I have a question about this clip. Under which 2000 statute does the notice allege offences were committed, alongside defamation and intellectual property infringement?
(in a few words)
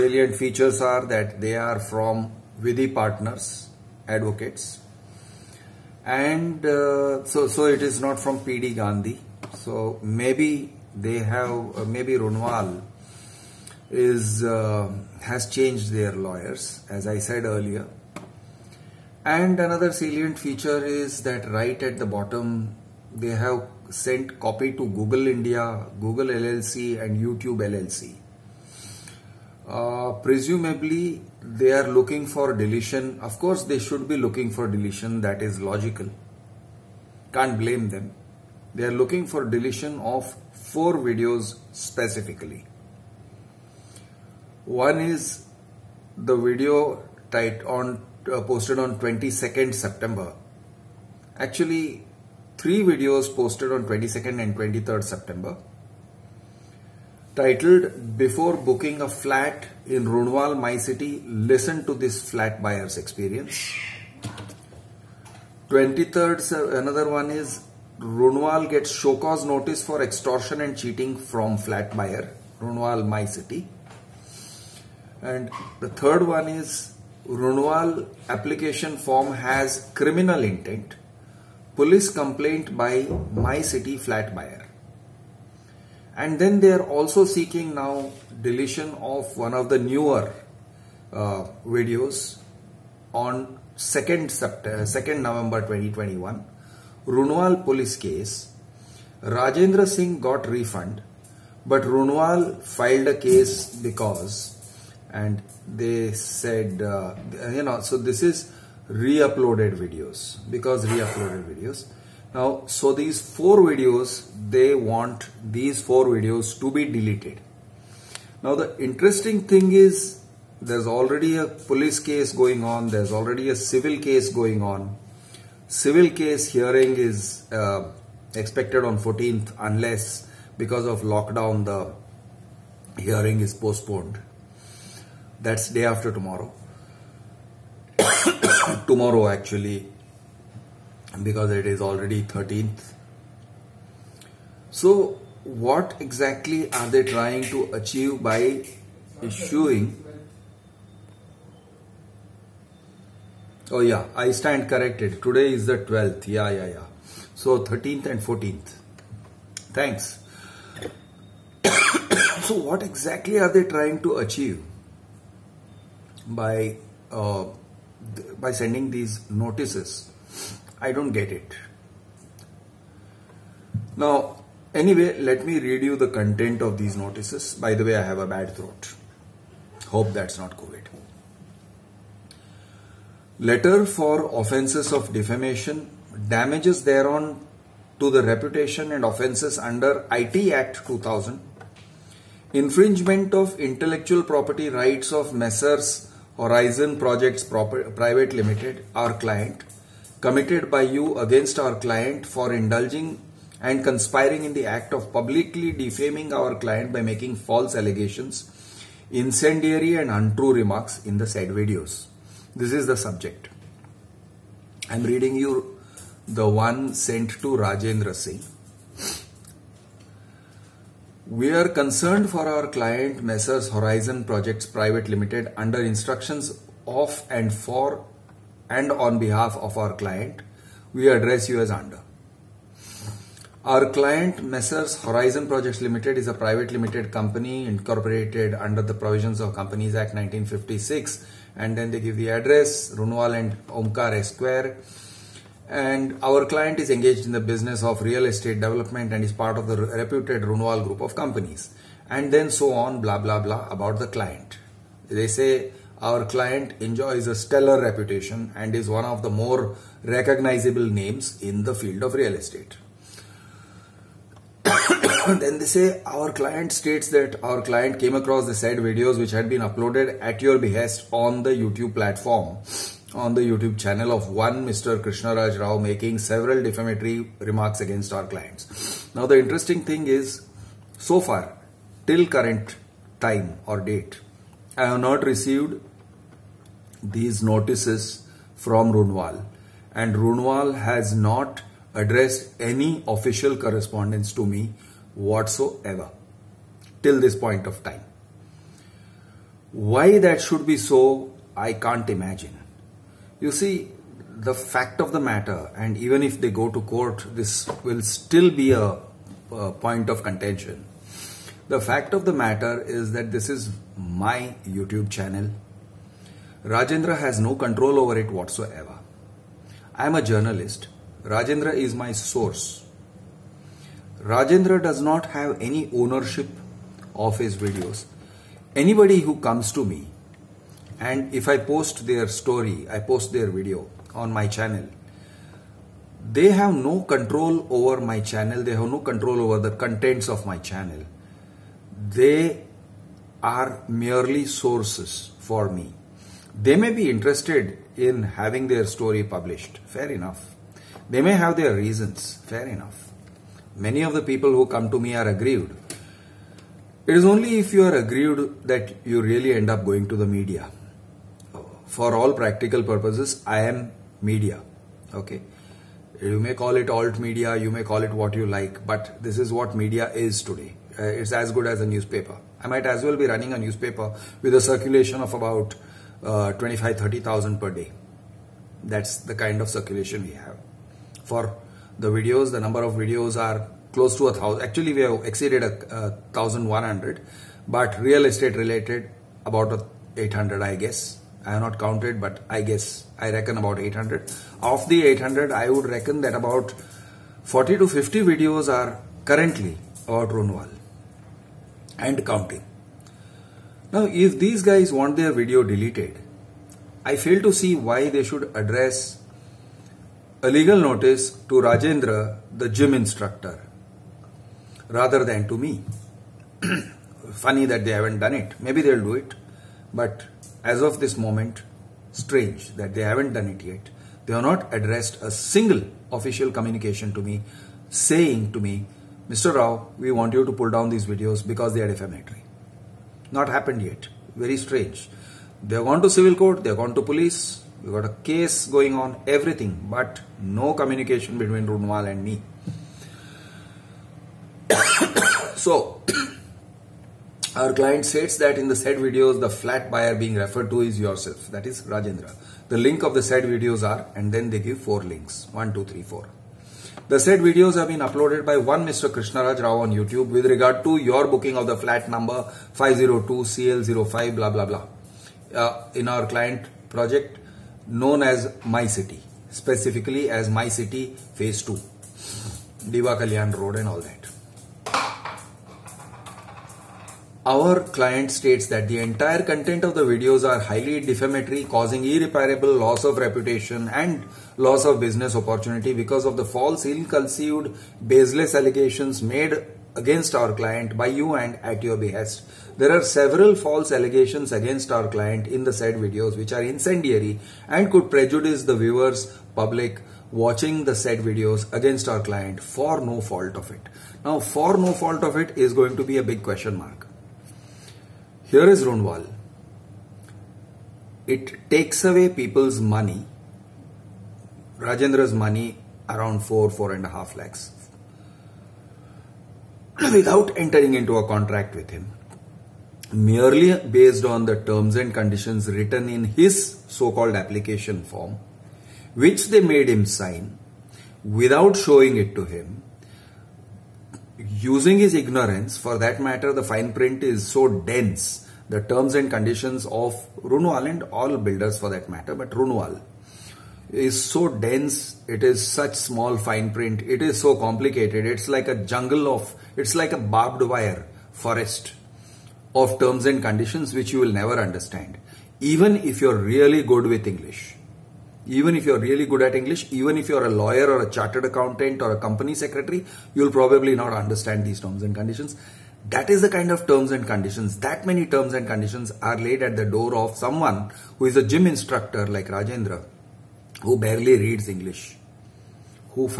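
IT Act 2000.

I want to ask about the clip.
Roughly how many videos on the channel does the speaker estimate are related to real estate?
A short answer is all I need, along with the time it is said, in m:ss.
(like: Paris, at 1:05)
800, at 6:29.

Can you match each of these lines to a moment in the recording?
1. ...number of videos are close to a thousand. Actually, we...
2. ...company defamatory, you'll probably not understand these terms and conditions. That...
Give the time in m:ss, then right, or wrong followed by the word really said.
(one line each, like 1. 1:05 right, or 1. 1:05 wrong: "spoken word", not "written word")
1. 6:22 right
2. 9:22 wrong: "secretary", not "defamatory".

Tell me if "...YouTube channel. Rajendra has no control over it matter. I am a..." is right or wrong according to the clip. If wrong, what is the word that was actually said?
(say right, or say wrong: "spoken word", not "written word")
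wrong: "whatsoever", not "matter".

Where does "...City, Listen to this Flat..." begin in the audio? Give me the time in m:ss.
1:00.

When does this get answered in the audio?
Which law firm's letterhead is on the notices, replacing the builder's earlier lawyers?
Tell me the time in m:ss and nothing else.
0:02.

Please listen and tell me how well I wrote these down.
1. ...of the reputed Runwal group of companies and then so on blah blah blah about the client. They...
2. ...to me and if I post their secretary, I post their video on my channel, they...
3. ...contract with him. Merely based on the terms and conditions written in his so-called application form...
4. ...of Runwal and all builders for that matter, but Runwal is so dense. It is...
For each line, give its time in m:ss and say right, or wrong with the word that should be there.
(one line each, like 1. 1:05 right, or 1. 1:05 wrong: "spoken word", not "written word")
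1. 4:09 right
2. 5:29 wrong: "story", not "secretary"
3. 8:41 right
4. 8:59 right.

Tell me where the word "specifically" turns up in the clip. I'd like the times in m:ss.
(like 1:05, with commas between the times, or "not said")
0:41, 7:49.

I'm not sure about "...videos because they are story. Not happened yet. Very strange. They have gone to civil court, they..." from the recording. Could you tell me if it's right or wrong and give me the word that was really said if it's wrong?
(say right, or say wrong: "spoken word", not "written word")
wrong: "defamatory", not "story".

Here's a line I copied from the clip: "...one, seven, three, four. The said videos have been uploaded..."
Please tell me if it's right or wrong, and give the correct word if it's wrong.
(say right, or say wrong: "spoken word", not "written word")
wrong: "two", not "seven".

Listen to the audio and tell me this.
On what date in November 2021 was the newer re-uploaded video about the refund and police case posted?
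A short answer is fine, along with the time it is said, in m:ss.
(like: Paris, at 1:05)
2nd November 2021, at 1:34.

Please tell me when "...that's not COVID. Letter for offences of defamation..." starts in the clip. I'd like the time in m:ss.
3:00.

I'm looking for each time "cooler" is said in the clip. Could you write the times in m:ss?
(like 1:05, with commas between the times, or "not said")
not said.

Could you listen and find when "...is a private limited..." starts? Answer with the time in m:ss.
3:56.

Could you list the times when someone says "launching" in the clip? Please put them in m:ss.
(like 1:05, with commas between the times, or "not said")
not said.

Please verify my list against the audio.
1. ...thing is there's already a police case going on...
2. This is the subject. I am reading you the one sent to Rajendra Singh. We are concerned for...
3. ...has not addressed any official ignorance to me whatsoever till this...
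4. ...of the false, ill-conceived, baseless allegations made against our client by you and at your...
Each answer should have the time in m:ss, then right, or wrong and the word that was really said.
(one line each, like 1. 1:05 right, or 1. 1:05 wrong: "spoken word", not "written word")
1. 1:59 right
2. 3:32 right
3. 4:50 wrong: "correspondence", not "ignorance"
4. 8:06 right.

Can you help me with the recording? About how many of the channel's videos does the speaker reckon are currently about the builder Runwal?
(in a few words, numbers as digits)
40 to 50.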